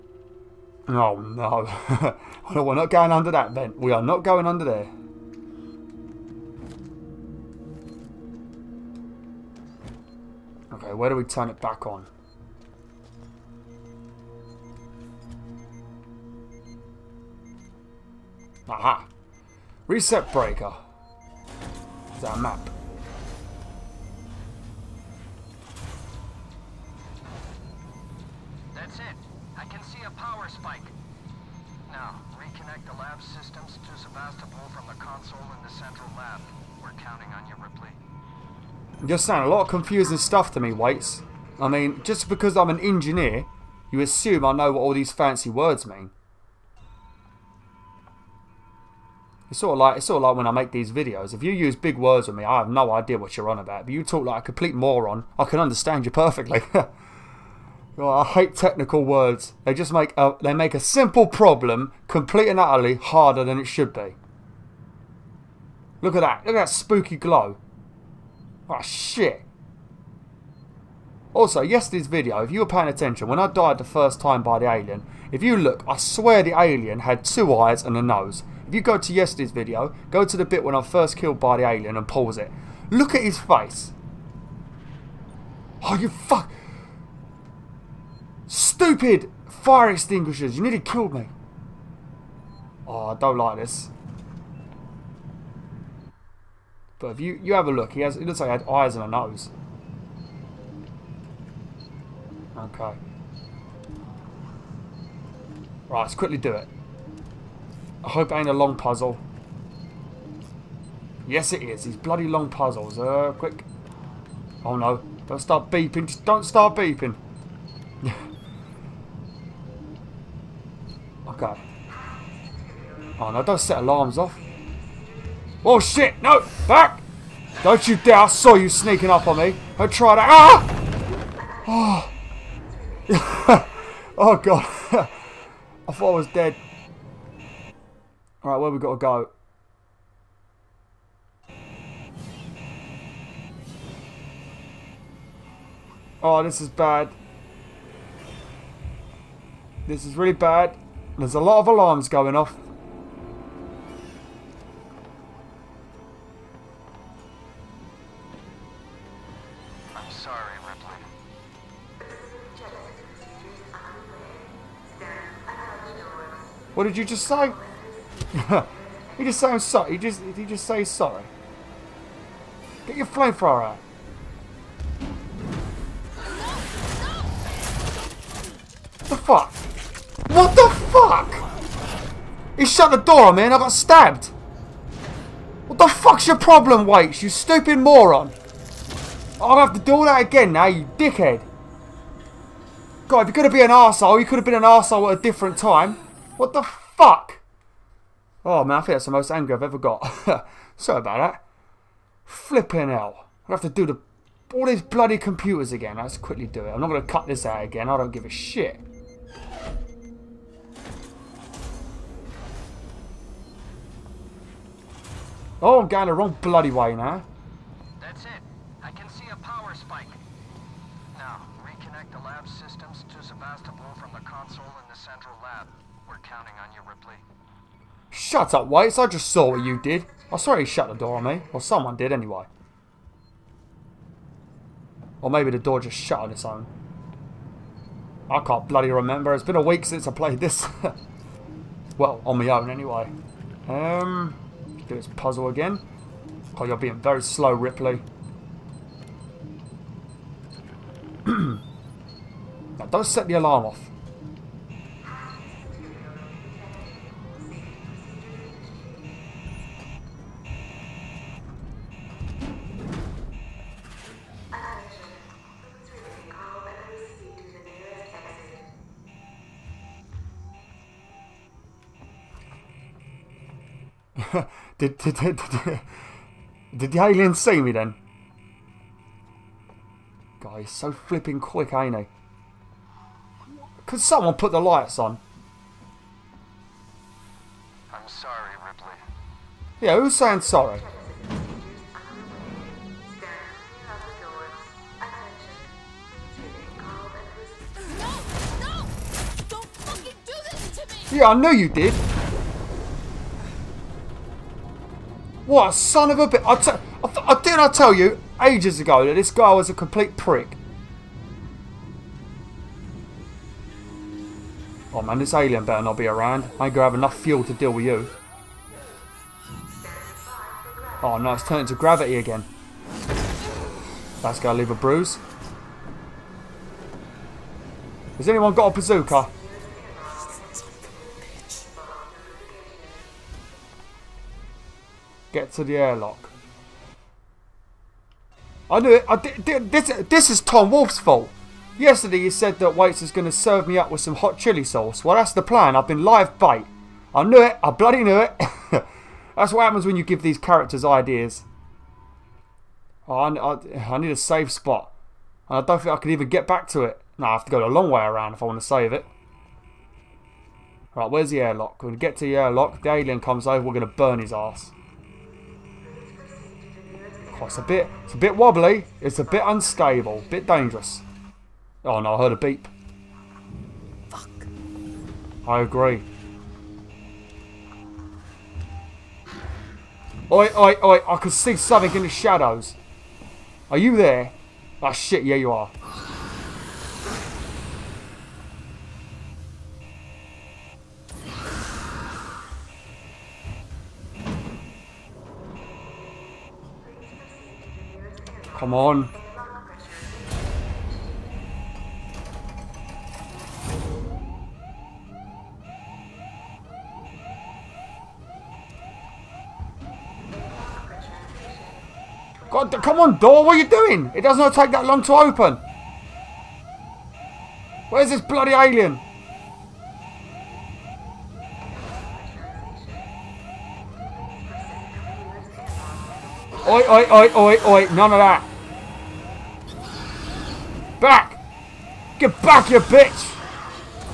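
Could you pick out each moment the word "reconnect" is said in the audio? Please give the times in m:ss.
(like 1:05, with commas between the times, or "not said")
0:32, 3:41.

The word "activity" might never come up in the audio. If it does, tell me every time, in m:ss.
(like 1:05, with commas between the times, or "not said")
not said.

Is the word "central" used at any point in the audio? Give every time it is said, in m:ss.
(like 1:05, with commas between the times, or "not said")
0:35, 3:44.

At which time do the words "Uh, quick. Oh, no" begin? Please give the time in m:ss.
1:52.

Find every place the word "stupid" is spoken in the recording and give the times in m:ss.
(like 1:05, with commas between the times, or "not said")
1:28, 3:07.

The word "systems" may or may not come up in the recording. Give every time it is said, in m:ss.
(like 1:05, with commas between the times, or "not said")
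0:33, 3:42.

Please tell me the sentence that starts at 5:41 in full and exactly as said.
Yesterday he said that Waits is going to serve me up with some hot chili sauce.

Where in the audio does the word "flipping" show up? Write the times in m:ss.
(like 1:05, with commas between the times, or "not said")
3:22, 4:40.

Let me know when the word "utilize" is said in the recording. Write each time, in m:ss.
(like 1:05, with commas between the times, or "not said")
not said.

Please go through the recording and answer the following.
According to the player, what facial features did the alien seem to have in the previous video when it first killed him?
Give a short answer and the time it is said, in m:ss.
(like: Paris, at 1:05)
Two eyes and a nose, at 1:17.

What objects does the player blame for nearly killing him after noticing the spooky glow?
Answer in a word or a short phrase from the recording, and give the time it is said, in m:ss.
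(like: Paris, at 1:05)
Fire extinguishers, at 1:29.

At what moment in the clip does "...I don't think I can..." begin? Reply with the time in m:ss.
5:55.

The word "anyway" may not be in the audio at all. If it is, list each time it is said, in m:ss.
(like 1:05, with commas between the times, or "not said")
3:52, 4:02.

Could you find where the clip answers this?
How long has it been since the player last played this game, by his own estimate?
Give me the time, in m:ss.
3:59.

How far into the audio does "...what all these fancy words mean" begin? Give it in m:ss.
0:44.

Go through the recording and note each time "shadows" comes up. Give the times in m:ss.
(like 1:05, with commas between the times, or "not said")
6:22.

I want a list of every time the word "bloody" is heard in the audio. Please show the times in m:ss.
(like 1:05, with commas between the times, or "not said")
1:51, 3:24, 3:36, 3:58, 5:47, 6:58.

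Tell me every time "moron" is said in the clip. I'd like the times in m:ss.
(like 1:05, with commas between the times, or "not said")
0:54, 3:07.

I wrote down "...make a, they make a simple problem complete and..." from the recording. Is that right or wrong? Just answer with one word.
right.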